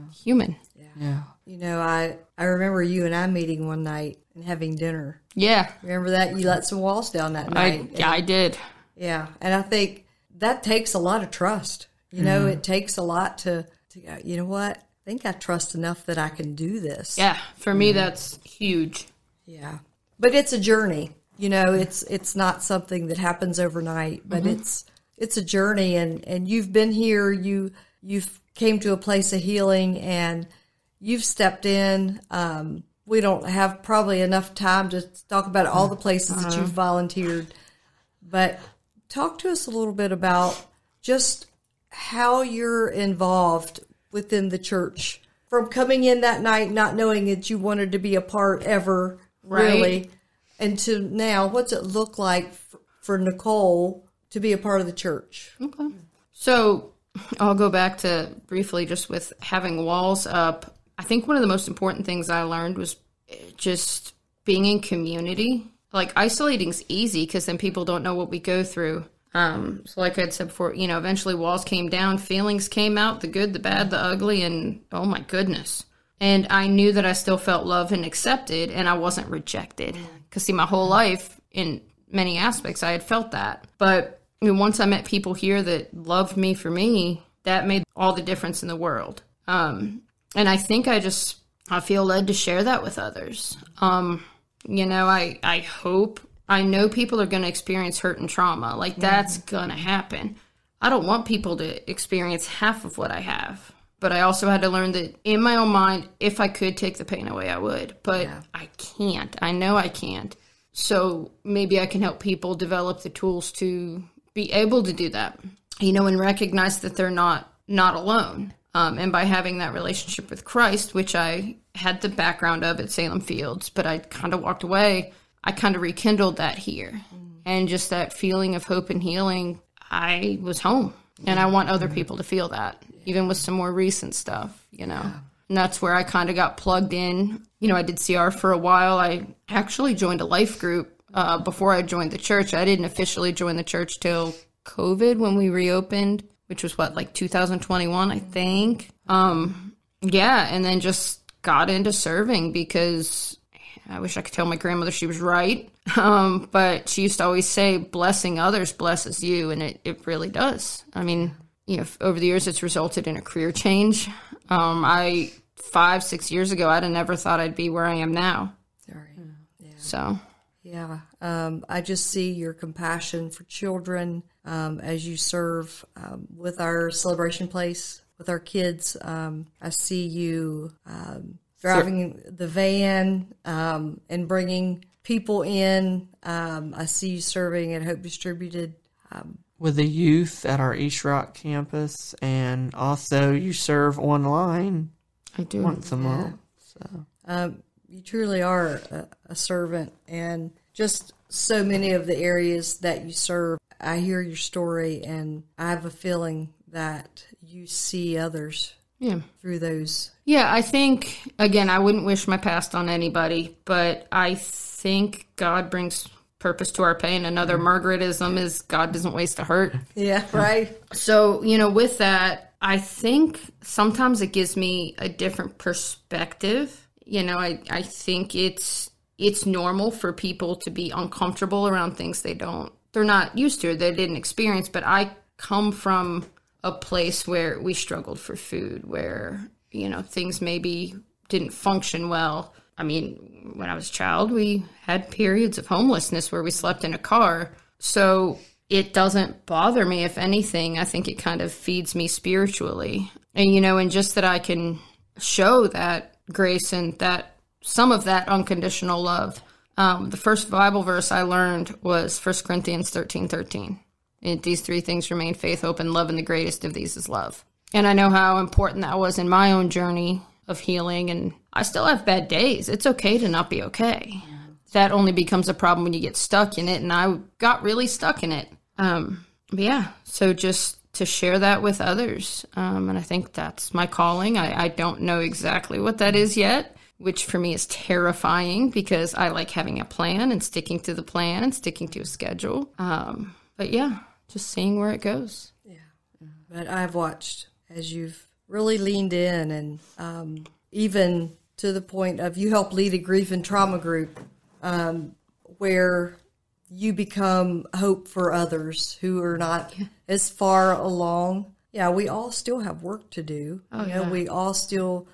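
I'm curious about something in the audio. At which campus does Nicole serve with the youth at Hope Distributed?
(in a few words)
East Rock.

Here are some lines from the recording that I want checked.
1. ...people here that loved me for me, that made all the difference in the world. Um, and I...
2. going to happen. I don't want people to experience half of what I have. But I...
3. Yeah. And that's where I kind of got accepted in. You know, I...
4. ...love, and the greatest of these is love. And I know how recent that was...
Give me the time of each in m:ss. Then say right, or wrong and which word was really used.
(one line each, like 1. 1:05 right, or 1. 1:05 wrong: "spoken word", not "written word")
1. 1:25 right
2. 1:39 right
3. 2:15 wrong: "plugged", not "accepted"
4. 4:25 wrong: "important", not "recent".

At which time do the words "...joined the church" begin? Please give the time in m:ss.
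2:21.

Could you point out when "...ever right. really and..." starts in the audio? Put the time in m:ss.
0:48.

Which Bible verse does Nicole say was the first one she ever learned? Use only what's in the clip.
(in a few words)
1 Corinthians 13:13.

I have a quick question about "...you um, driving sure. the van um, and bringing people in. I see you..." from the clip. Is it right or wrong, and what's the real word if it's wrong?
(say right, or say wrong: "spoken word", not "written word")
right.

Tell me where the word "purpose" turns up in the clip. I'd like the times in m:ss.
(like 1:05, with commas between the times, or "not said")
3:36.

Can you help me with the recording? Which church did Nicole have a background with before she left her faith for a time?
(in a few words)
Salem Fields.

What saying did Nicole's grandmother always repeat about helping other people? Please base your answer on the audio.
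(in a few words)
Blessing others blesses you.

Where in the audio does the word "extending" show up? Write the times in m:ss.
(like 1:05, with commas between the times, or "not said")
not said.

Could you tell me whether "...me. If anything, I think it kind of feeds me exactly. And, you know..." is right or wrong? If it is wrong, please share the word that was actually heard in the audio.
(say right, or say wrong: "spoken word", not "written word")
wrong: "spiritually", not "exactly".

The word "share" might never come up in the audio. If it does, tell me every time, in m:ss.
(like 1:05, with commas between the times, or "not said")
1:32, 4:41.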